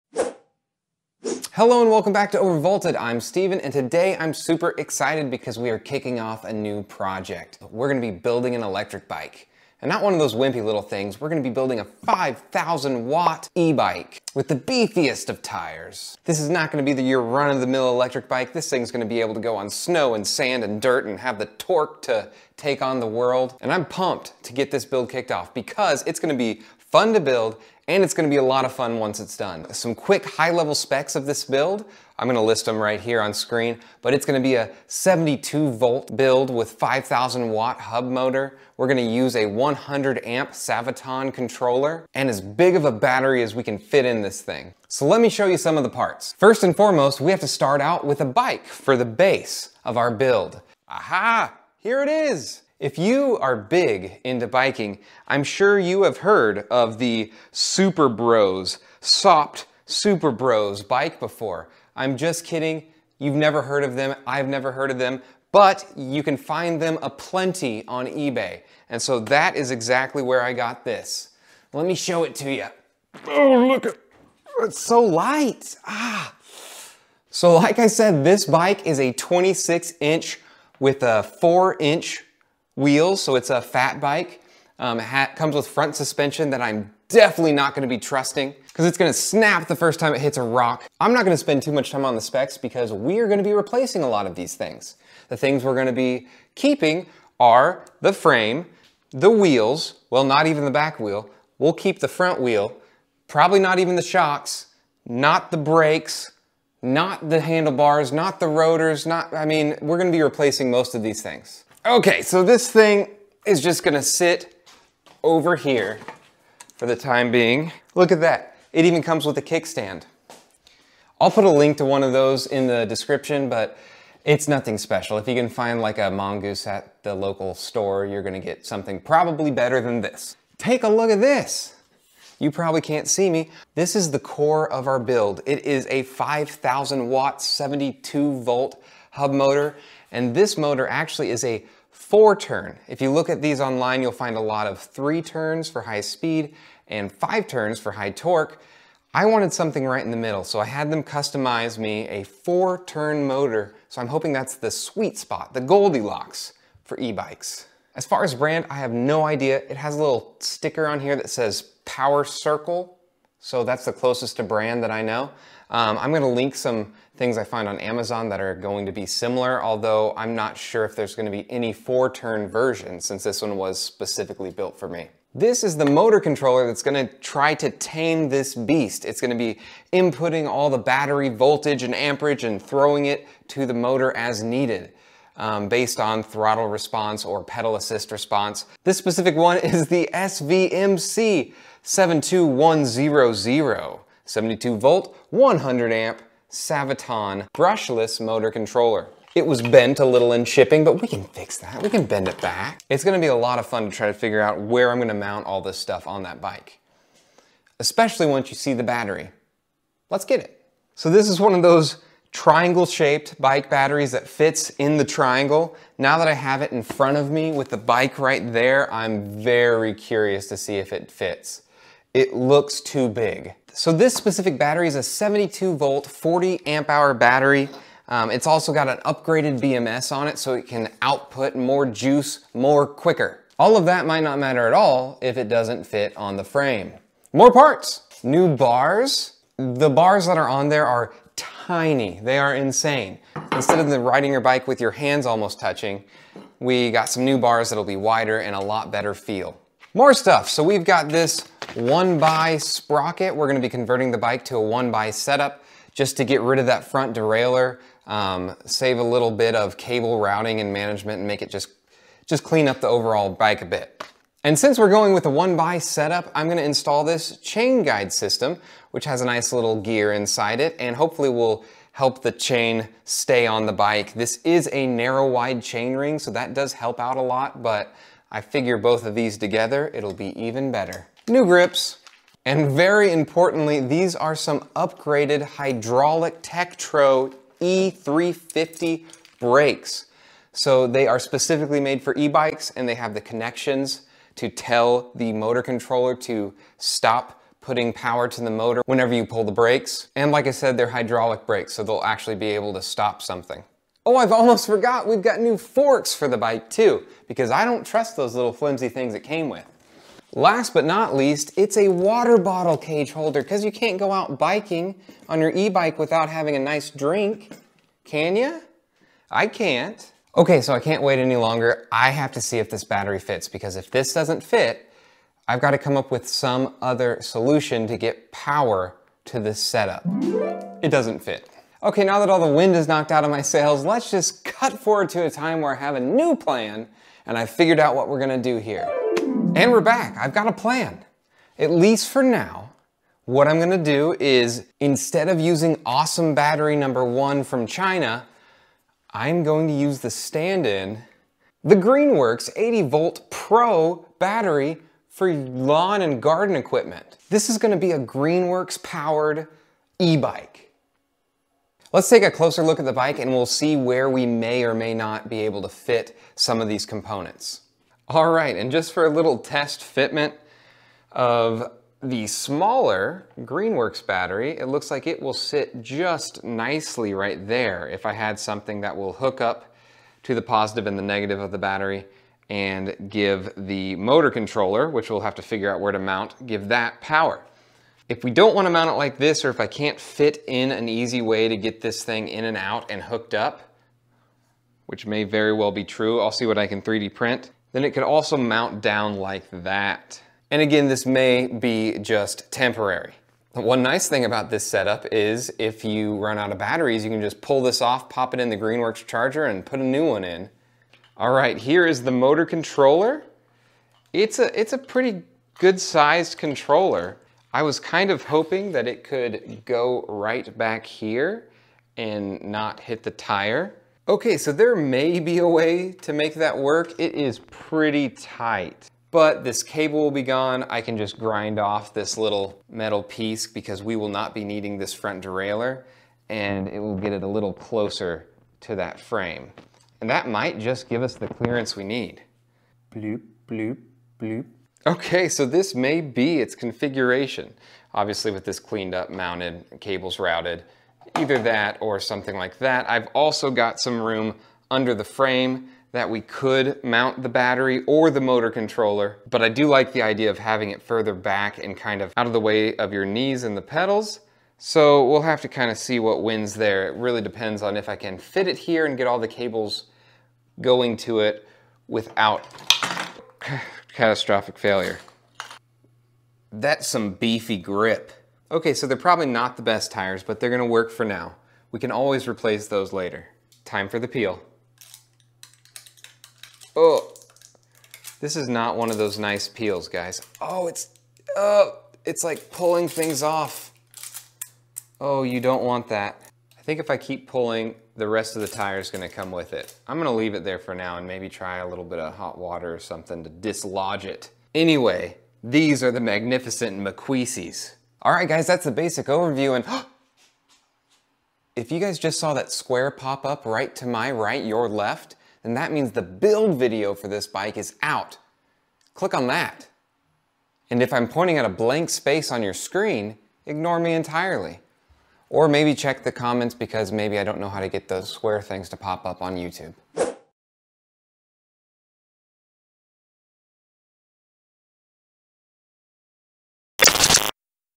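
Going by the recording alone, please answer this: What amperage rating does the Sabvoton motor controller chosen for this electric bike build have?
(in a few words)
100 amp.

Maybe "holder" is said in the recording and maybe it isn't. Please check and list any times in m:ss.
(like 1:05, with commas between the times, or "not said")
5:13.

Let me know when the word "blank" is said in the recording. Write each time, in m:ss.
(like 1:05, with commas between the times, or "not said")
8:41.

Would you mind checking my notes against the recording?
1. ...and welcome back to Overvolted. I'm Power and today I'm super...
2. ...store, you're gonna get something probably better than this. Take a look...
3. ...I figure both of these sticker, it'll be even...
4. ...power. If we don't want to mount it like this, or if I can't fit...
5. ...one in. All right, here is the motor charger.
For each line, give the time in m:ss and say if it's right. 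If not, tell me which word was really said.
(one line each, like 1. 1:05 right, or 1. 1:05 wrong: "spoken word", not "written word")
1. 0:01 wrong: "Steven", not "Power"
2. 2:07 right
3. 4:38 wrong: "together", not "sticker"
4. 6:26 right
5. 6:50 wrong: "controller", not "charger".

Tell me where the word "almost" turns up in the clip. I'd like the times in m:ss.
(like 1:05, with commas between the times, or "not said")
4:05, 5:04.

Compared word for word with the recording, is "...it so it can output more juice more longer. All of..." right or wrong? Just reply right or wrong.
wrong.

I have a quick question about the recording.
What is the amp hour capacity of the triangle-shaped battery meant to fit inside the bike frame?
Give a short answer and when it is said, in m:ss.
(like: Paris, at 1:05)
40 amp hour, at 3:46.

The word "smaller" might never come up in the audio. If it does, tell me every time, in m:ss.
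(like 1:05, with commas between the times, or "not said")
6:12.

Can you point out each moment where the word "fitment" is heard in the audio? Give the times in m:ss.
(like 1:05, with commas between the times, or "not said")
6:09.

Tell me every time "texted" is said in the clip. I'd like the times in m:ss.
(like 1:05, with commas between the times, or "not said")
not said.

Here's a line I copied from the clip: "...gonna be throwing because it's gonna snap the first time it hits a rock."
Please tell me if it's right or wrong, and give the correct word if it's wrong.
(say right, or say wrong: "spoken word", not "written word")
wrong: "trusting", not "throwing".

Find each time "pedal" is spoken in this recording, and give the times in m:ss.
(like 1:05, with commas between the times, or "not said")
3:07, 7:43.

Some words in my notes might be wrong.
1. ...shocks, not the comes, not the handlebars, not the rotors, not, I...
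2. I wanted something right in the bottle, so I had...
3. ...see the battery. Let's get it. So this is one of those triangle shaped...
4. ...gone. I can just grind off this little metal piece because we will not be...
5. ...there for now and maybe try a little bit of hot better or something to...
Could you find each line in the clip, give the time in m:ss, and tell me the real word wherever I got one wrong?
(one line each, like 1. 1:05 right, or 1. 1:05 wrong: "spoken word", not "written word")
1. 1:44 wrong: "brakes", not "comes"
2. 2:29 wrong: "middle", not "bottle"
3. 3:28 right
4. 7:10 right
5. 8:20 wrong: "water", not "better".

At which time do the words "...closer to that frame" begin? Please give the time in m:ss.
7:17.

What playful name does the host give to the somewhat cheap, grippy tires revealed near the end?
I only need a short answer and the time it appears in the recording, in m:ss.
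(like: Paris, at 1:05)
McQueesies, at 8:26.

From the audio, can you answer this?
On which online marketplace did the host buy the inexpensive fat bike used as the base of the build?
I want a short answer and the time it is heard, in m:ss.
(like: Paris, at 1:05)
eBay, at 1:08.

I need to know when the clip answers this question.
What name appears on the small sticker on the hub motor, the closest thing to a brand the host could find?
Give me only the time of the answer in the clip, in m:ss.
2:41.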